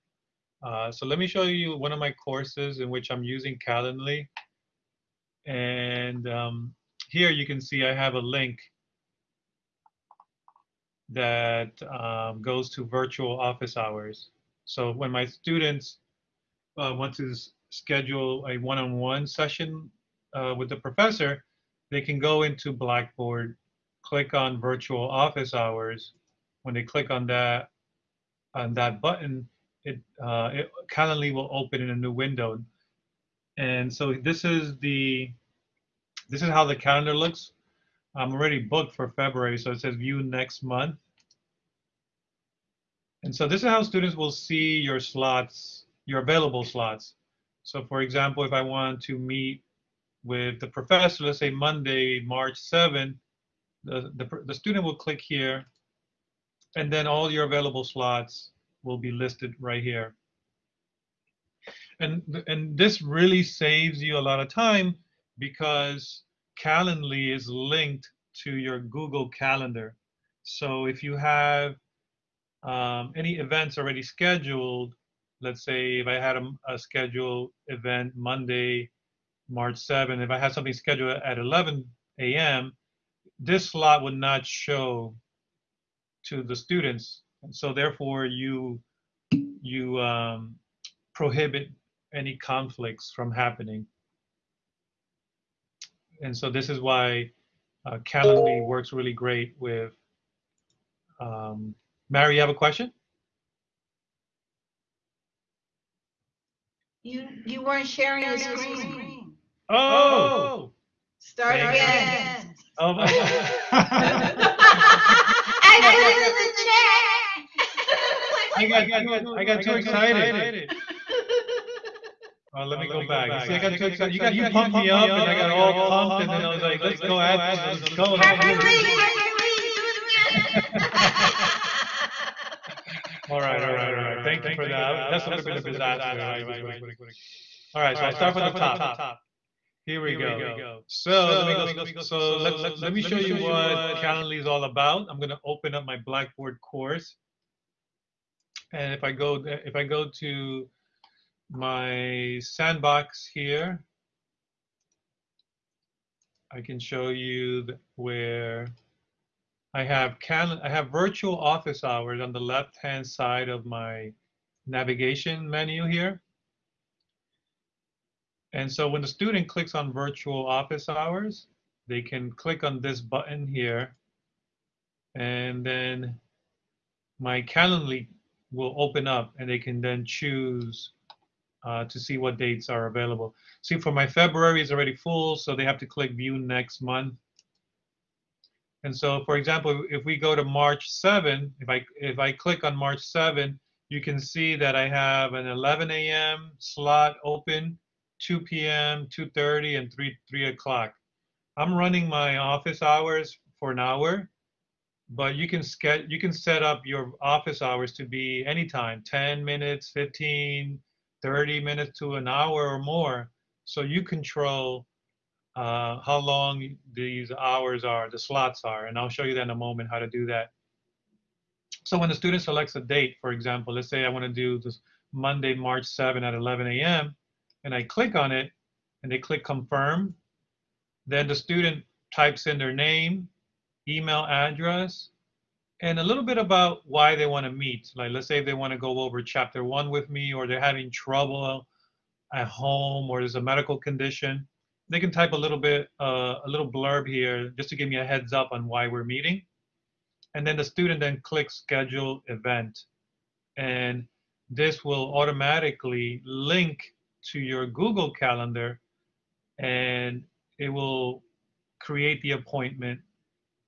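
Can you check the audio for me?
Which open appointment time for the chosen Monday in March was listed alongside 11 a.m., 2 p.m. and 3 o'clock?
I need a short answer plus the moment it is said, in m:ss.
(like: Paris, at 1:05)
2:30, at 3:19.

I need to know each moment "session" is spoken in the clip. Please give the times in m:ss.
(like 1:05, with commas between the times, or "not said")
0:19.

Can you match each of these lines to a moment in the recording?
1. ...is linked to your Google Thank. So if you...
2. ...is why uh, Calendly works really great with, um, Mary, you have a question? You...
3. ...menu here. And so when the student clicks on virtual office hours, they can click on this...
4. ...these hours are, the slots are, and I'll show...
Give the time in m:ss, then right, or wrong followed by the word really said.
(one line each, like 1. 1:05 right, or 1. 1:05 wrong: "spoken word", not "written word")
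1. 1:07 wrong: "Calendar", not "Thank"
2. 1:36 right
3. 2:45 right
4. 3:36 right.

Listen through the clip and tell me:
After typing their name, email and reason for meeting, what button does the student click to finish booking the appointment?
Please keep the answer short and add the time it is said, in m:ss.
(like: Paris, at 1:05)
schedule event, at 4:11.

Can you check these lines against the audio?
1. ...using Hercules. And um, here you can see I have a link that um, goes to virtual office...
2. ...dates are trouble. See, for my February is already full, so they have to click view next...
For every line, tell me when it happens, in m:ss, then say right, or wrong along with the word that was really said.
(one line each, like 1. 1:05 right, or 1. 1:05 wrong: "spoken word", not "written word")
1. 0:03 wrong: "Calendly", not "Hercules"
2. 3:02 wrong: "available", not "trouble".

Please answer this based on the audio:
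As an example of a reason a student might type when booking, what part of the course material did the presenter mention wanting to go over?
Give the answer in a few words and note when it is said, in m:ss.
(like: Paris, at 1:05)
chapter one, at 3:59.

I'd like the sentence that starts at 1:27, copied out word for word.
so therefore you, you um, prohibit any conflicts from happening.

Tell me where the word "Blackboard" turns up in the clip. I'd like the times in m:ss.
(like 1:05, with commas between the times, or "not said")
0:22, 2:25.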